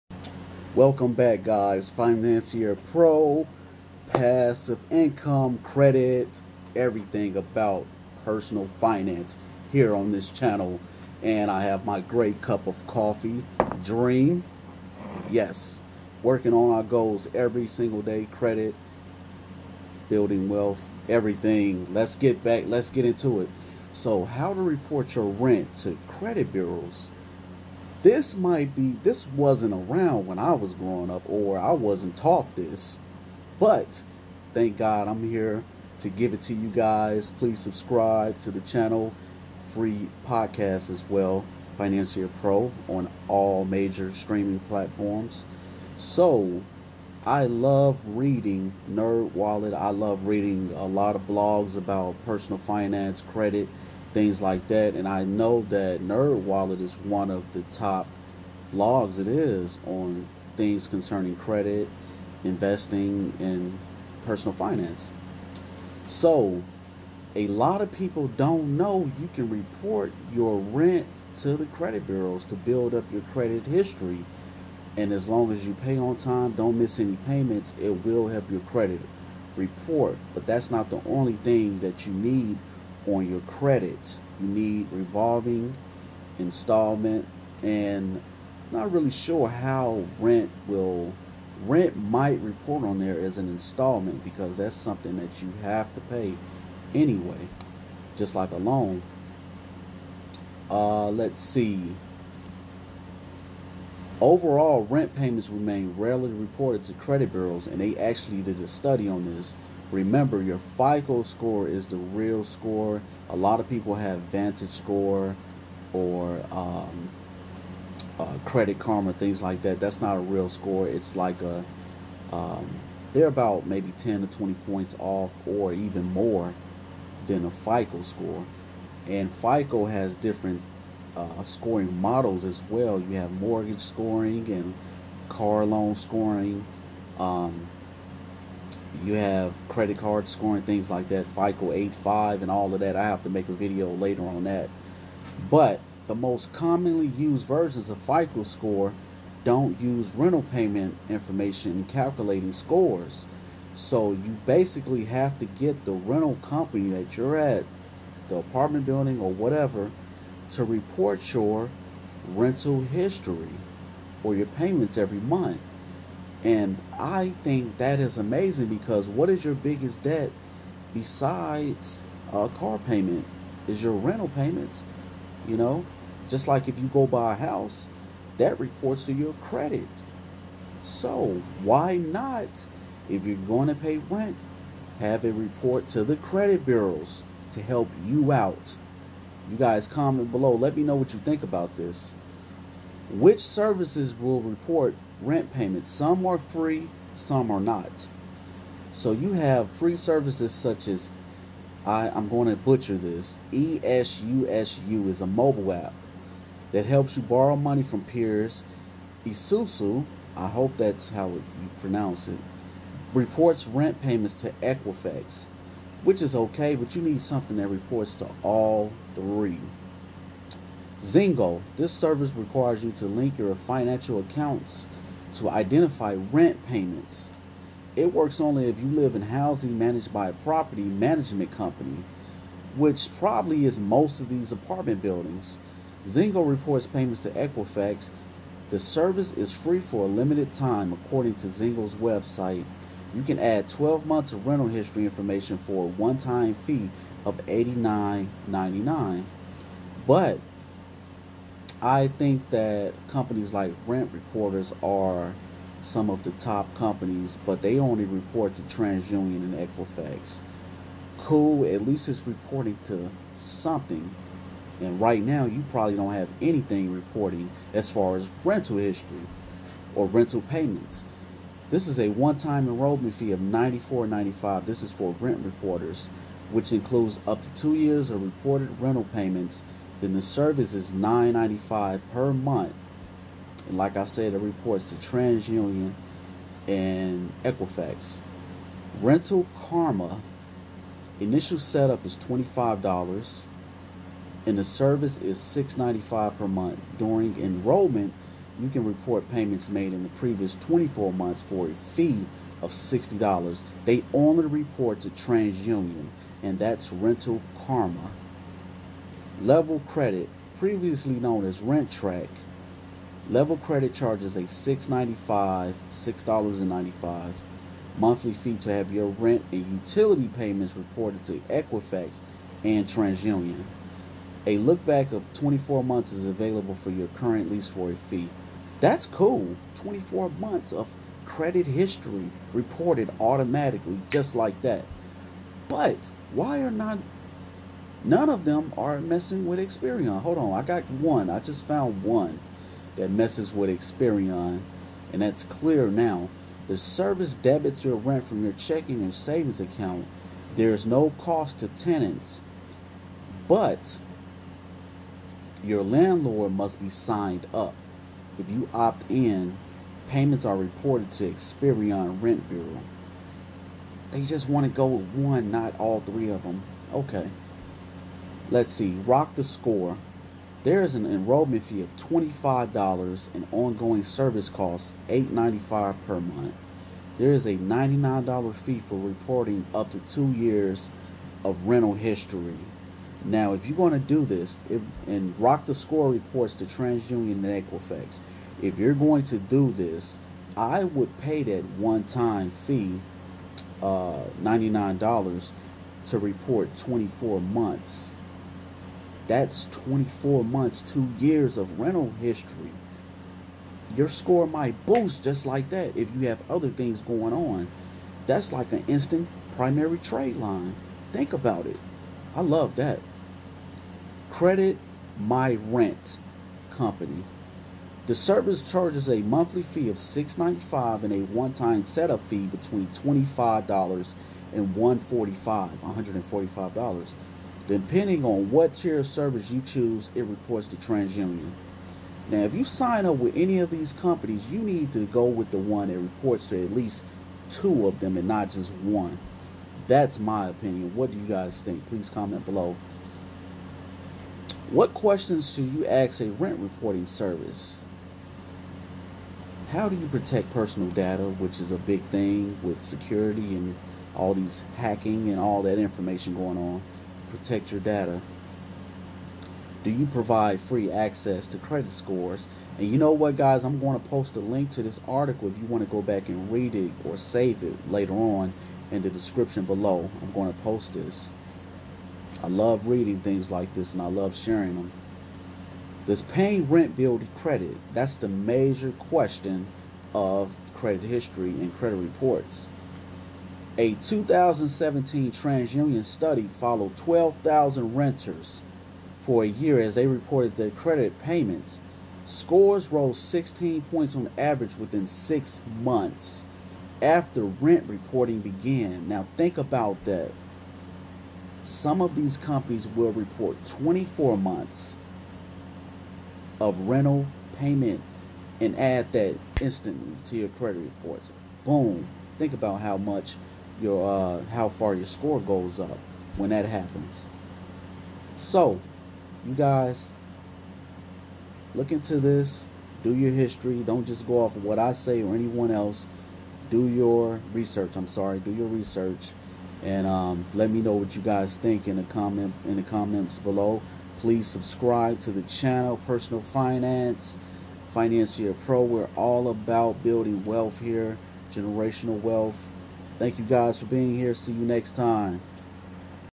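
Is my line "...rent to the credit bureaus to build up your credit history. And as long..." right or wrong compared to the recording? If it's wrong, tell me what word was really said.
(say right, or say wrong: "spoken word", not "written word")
right.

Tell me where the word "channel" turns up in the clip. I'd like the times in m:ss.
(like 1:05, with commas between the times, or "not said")
0:10, 0:38, 8:55.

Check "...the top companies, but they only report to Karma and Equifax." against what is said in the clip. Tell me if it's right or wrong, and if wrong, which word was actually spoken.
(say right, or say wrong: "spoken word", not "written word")
wrong: "TransUnion", not "Karma".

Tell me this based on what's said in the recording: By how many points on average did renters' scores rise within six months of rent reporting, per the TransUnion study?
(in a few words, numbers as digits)
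16.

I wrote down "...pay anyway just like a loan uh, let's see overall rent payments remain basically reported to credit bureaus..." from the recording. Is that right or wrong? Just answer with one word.
wrong.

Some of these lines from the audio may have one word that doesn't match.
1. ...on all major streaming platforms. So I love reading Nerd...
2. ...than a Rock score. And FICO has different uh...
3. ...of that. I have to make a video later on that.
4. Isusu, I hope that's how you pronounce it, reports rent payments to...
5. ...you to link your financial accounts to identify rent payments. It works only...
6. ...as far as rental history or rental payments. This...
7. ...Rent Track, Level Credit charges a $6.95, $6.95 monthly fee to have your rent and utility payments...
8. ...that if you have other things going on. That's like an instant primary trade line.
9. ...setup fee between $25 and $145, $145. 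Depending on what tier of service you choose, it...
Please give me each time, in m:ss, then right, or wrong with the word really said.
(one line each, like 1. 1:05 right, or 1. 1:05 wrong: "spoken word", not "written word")
1. 0:42 right
2. 2:07 wrong: "FICO", not "Rock"
3. 2:22 right
4. 3:29 right
5. 3:42 right
6. 4:27 right
7. 5:11 right
8. 6:45 right
9. 7:01 right.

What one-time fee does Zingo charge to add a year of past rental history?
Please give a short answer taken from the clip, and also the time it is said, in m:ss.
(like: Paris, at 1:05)
$89.99, at 4:07.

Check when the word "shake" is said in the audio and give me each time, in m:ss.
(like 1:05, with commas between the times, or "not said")
not said.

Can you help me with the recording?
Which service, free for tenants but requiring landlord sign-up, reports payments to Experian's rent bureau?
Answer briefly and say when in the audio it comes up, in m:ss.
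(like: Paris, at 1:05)
ClearNow, at 5:45.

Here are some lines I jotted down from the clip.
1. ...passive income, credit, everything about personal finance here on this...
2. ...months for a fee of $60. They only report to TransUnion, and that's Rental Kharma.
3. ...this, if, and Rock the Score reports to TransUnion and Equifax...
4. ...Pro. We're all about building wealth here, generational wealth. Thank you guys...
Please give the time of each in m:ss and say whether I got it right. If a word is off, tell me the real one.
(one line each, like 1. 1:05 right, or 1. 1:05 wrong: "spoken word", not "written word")
1. 0:04 right
2. 5:01 right
3. 6:24 right
4. 8:58 right.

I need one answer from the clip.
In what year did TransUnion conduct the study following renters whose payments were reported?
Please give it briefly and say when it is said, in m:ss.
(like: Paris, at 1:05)
2017, at 8:04.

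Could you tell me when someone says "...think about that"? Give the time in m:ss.
8:19.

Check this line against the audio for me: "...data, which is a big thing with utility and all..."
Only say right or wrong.
wrong.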